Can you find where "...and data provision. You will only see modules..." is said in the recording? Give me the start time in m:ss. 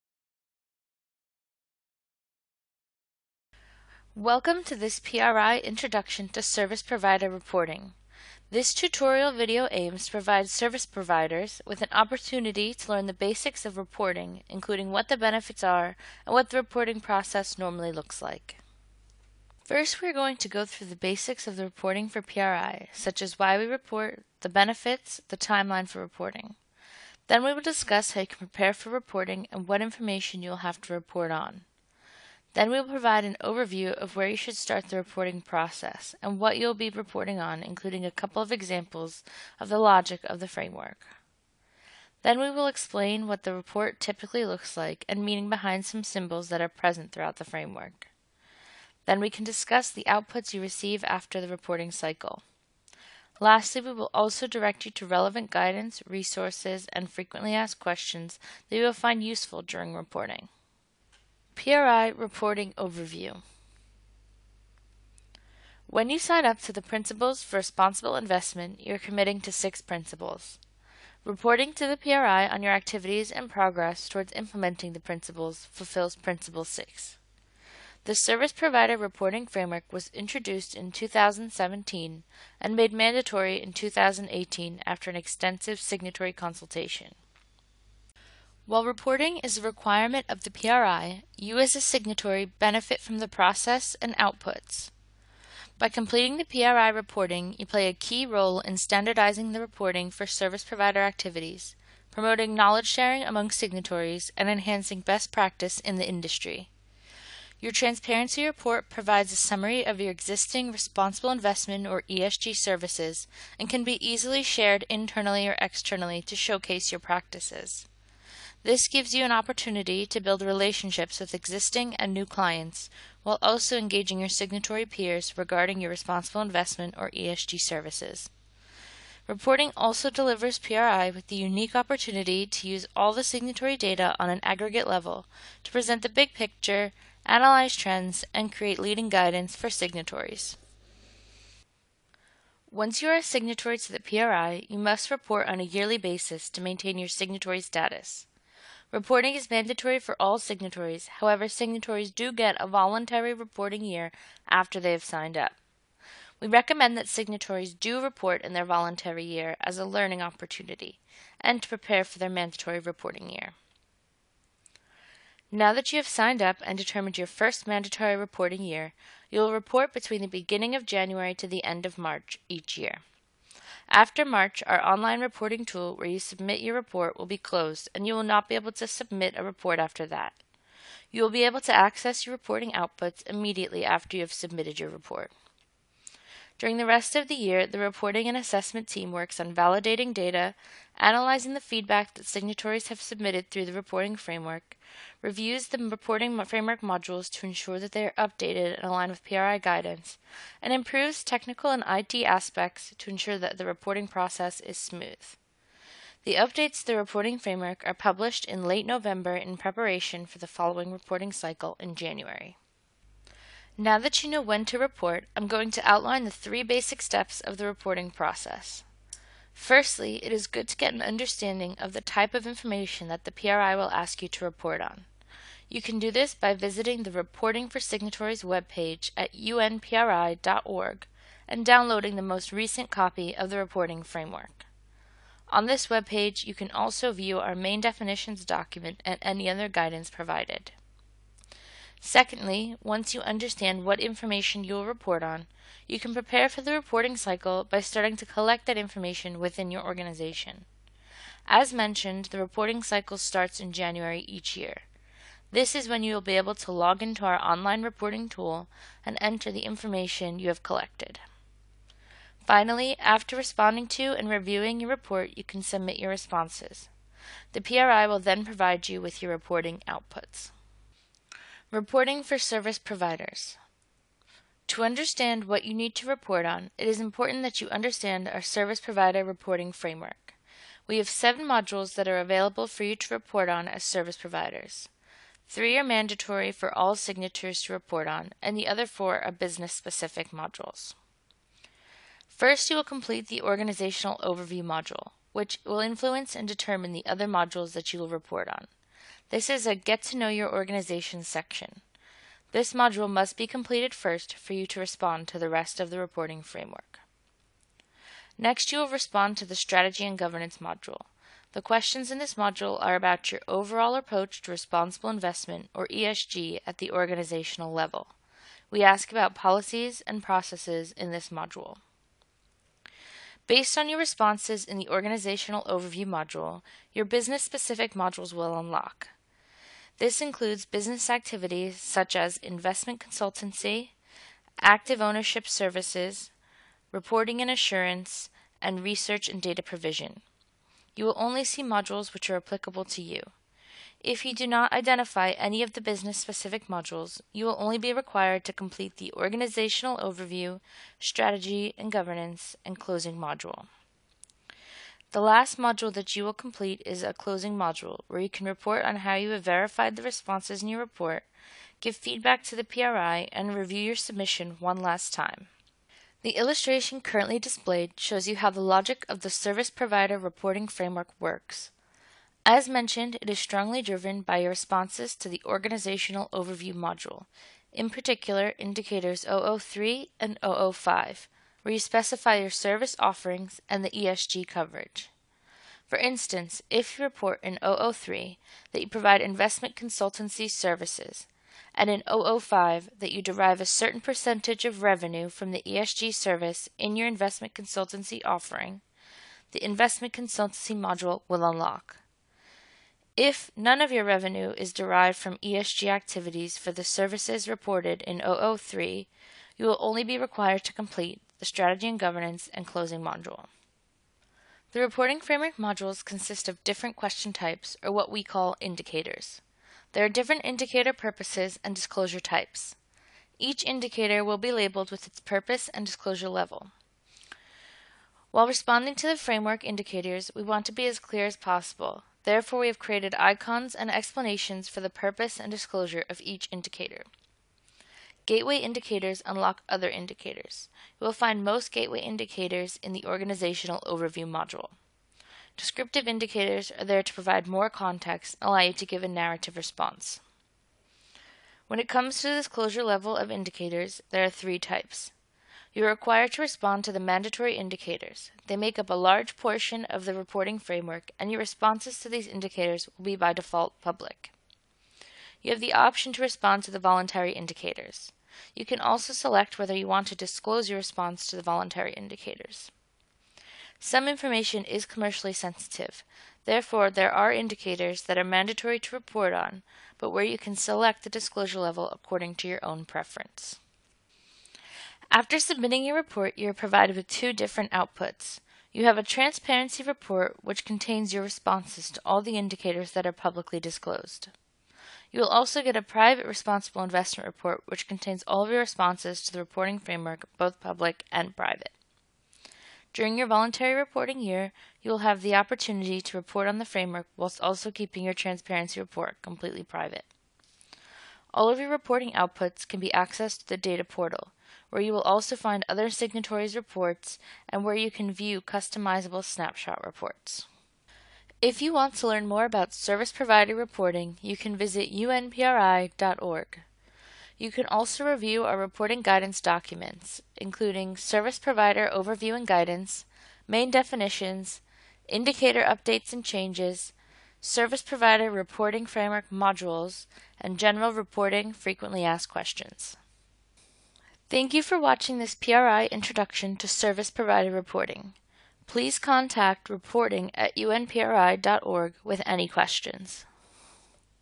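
5:39.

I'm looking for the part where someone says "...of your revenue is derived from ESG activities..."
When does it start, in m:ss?
6:43.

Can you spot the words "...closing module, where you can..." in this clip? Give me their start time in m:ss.
5:57.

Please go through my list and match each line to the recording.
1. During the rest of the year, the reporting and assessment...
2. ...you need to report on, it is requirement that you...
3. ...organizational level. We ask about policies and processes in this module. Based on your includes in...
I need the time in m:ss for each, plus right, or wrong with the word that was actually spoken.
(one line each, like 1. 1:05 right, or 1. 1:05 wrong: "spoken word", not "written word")
1. 3:06 right
2. 4:35 wrong: "important", not "requirement"
3. 5:16 wrong: "responses", not "includes".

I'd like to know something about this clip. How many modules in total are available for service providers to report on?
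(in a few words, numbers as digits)
7.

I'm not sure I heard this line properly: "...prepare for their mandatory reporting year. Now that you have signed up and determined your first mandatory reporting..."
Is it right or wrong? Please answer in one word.
right.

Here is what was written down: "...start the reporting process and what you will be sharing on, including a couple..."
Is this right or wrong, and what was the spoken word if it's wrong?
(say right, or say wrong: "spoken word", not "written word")
wrong: "reporting", not "sharing".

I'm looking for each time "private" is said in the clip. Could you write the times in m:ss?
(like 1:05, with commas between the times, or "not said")
8:15, 8:21, 8:29.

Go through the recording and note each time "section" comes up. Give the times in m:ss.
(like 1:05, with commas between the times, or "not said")
5:01.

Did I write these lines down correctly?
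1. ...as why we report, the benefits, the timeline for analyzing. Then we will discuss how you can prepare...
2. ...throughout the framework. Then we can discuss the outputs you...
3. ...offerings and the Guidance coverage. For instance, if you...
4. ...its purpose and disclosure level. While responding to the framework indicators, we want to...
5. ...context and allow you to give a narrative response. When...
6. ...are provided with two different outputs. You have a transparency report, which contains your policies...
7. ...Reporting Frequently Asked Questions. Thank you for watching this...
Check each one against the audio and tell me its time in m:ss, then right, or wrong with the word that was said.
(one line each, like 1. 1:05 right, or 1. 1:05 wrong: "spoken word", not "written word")
1. 0:23 wrong: "reporting", not "analyzing"
2. 0:47 right
3. 6:22 wrong: "ESG", not "Guidance"
4. 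7:05 right
5. 7:27 right
6. 8:06 wrong: "responses", not "policies"
7. 9:00 right.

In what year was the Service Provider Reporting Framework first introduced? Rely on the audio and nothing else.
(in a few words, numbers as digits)
2017.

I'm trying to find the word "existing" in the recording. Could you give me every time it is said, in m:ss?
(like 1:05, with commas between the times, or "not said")
1:50, 2:01.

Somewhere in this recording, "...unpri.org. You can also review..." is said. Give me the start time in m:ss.
8:44.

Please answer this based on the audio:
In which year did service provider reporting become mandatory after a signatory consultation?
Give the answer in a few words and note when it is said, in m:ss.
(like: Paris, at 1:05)
2018, at 1:23.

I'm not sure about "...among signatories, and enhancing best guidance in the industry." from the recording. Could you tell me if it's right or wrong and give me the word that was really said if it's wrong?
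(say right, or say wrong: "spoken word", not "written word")
wrong: "practice", not "guidance".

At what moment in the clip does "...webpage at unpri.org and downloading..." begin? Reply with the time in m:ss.
3:48.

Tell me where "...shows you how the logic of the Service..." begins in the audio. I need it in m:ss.
6:07.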